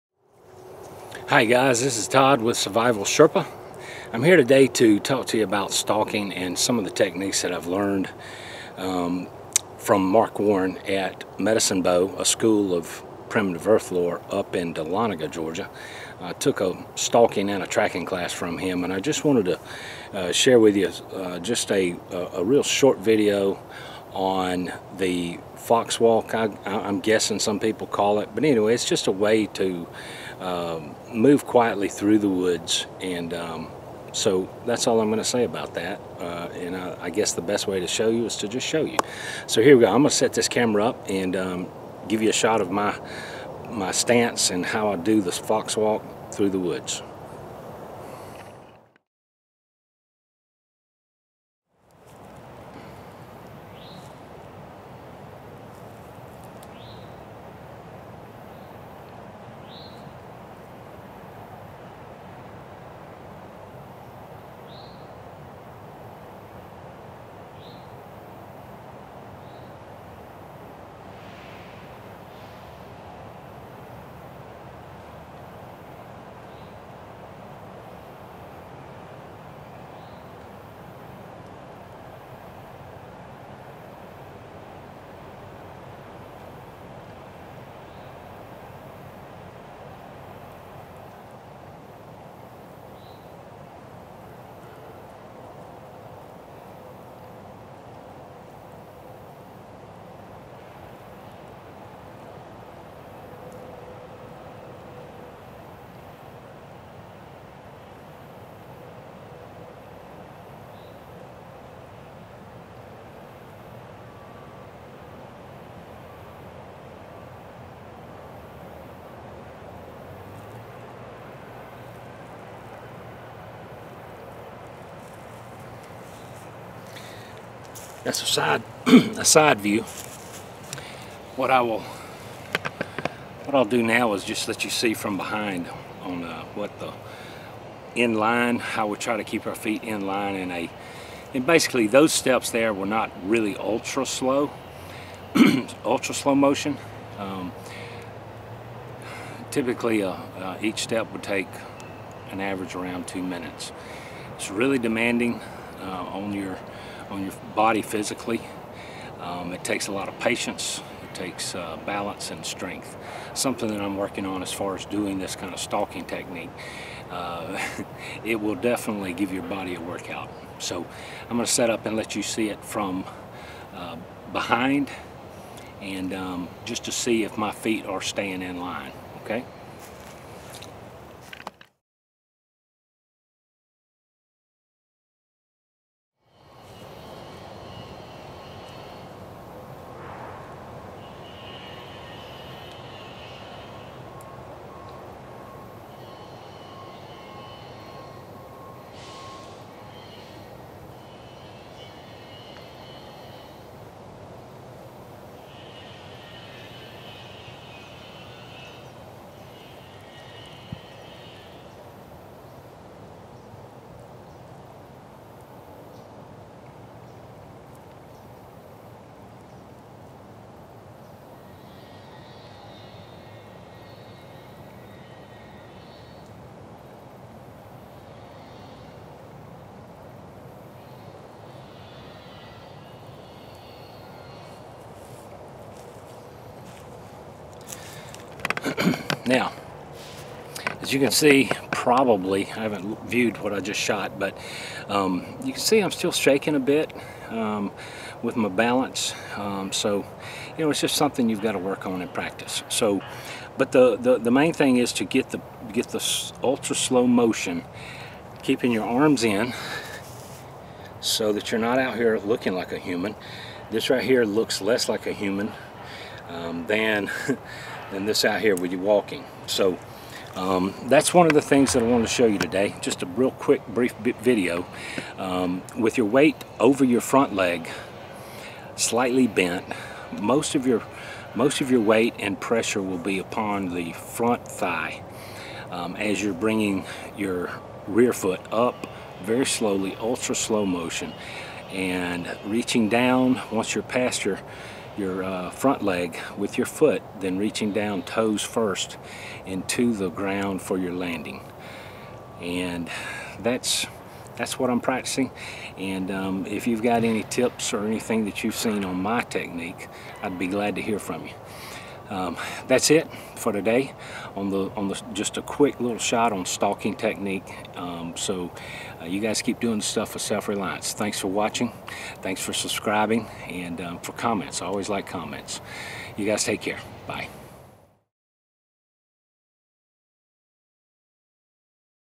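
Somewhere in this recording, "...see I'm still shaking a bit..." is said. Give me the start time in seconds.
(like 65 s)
245 s.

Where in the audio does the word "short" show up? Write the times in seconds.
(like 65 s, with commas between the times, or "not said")
22 s.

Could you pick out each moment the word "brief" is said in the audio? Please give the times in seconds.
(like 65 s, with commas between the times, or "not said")
273 s.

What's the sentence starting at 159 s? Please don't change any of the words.
Um, it takes a lot of patience, it takes uh, balance and strength.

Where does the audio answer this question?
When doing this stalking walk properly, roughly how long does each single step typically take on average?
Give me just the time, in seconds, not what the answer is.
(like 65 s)
153 s.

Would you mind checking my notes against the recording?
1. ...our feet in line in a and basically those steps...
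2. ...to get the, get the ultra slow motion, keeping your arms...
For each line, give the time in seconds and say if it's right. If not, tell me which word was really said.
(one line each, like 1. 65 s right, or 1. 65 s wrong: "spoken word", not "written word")
1. 139 s right
2. 254 s right.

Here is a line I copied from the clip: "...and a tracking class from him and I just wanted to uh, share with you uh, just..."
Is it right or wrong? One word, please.
right.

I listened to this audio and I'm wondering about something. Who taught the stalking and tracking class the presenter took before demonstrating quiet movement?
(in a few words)
Mark Warren.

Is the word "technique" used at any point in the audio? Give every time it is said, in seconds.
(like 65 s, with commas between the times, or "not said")
6 s, 166 s, 309 s, 316 s.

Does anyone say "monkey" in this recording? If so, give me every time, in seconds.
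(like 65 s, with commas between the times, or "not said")
not said.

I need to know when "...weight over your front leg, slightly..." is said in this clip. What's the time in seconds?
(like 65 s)
276 s.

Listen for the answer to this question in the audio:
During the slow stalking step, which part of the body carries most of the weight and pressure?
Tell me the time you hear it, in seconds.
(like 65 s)
283 s.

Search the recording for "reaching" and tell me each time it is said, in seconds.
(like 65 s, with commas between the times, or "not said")
292 s, 297 s.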